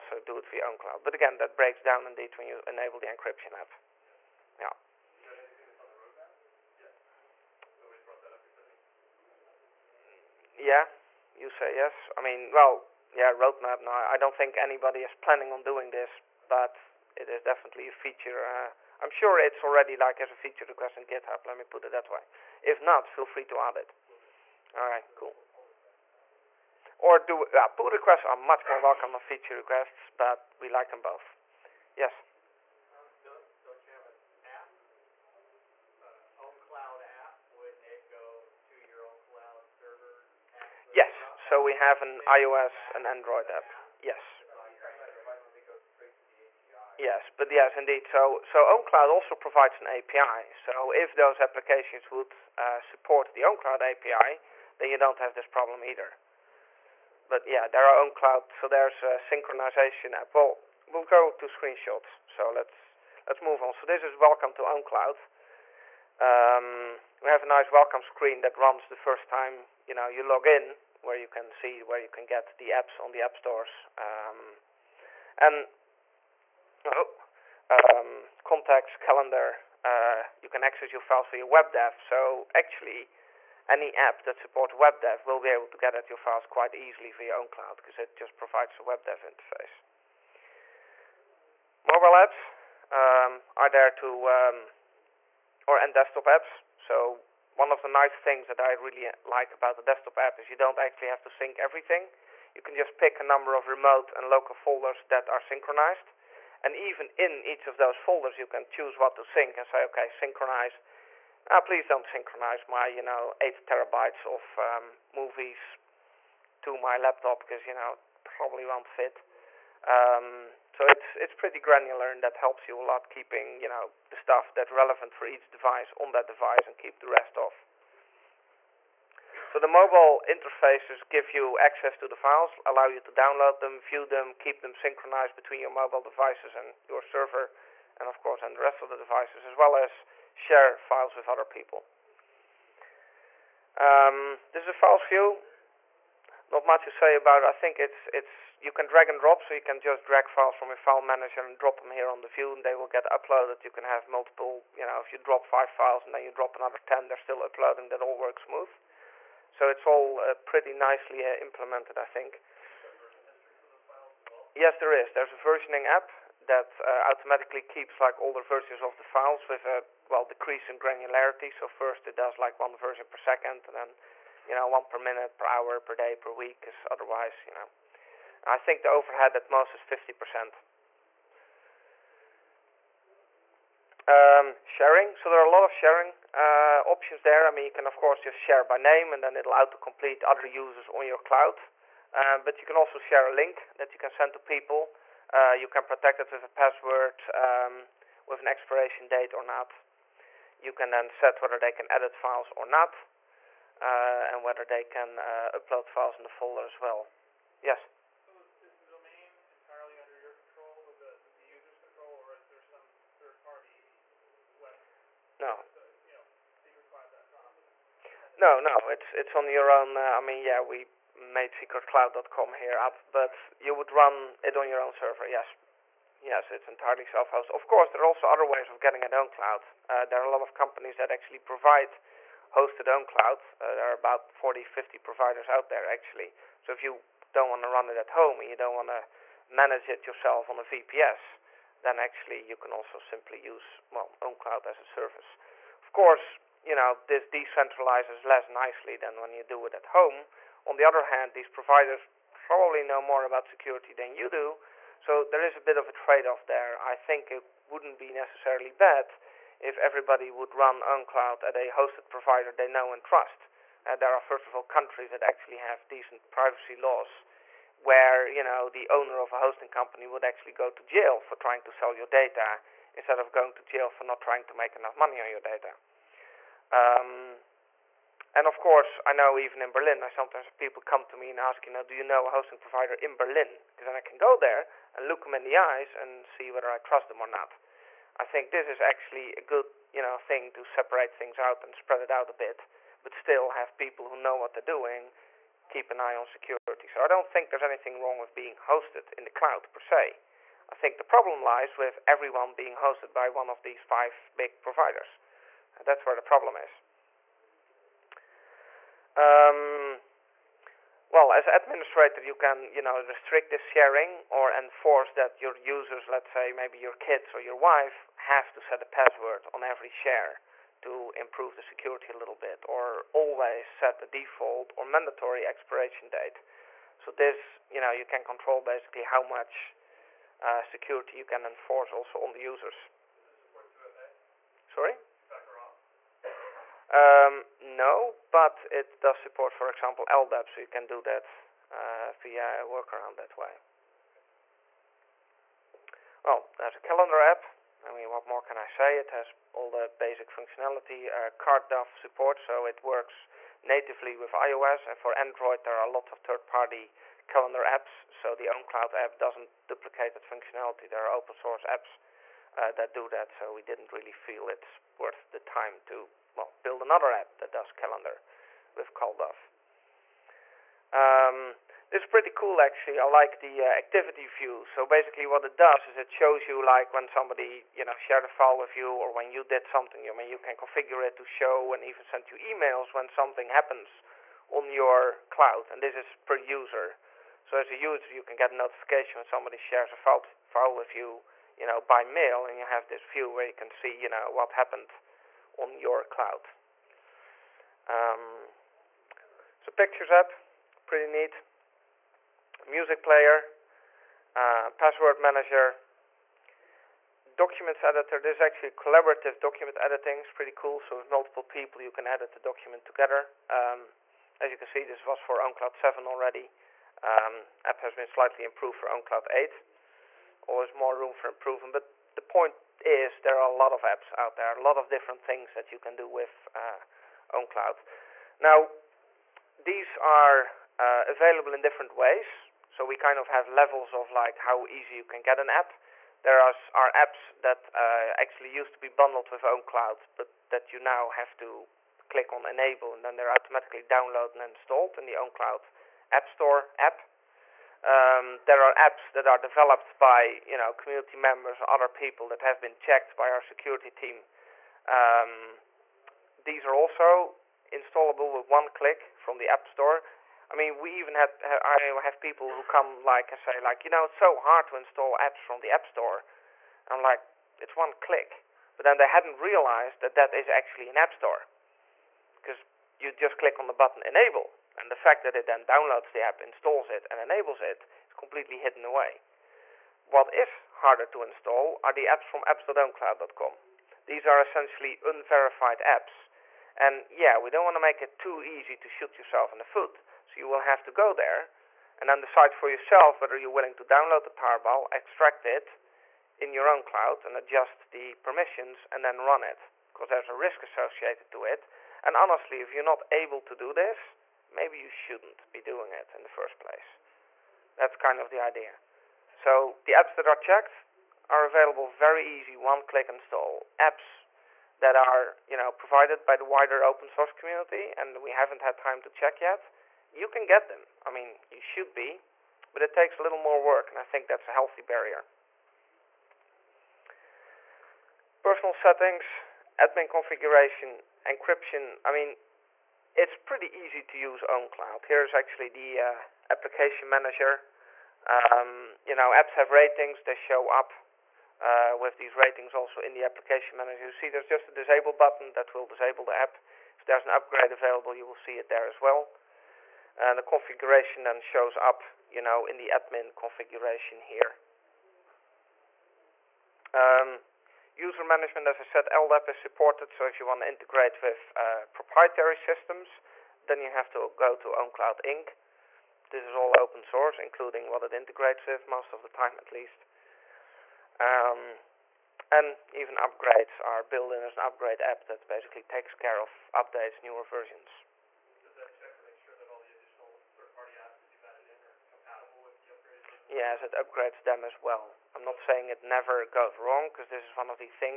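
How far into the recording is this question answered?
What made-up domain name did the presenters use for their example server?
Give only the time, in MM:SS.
03:41.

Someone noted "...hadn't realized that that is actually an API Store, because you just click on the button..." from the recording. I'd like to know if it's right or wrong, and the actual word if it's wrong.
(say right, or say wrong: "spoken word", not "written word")
wrong: "App", not "API".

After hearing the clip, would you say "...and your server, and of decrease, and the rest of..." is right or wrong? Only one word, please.
wrong.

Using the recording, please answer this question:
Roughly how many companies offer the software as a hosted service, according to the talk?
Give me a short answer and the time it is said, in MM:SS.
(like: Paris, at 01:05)
40 to 50, at 03:54.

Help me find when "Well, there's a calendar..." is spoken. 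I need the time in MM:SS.
05:46.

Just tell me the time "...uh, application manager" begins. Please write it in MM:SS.
08:56.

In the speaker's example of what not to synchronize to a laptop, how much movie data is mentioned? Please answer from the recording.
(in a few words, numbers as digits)
8 terabytes.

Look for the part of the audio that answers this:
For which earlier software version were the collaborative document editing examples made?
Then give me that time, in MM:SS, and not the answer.
06:55.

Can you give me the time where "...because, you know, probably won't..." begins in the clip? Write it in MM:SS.
01:57.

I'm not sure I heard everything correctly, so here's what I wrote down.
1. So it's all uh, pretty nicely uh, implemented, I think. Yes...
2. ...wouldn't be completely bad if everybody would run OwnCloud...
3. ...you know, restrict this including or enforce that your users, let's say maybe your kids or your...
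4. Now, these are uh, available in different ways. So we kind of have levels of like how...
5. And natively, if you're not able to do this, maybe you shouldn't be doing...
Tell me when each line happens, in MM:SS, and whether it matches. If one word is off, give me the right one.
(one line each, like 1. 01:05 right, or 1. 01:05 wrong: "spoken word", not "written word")
1. 02:39 right
2. 04:17 wrong: "necessarily", not "completely"
3. 05:12 wrong: "sharing", not "including"
4. 07:08 right
5. 08:22 wrong: "honestly", not "natively".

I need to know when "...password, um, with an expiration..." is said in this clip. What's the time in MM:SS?
03:16.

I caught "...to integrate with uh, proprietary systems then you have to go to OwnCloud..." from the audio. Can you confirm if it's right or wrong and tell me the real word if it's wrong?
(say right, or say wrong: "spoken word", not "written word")
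right.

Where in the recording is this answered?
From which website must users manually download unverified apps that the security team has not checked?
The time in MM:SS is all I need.
08:02.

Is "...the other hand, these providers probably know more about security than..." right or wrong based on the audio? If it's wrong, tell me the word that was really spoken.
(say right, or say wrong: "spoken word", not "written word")
right.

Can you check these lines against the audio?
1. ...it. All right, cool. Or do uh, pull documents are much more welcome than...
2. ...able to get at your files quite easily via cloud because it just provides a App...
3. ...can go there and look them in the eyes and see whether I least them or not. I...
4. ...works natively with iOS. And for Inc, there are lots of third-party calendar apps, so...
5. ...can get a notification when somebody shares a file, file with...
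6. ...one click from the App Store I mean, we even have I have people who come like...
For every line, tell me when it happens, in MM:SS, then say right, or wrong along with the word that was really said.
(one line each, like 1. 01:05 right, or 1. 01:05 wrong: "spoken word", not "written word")
1. 00:23 wrong: "requests", not "documents"
2. 01:25 wrong: "WebDAV", not "App"
3. 04:44 wrong: "trust", not "least"
4. 05:52 wrong: "Android", not "Inc"
5. 06:28 right
6. 07:38 right.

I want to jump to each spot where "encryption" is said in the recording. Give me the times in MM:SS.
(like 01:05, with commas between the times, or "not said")
00:03, 08:51.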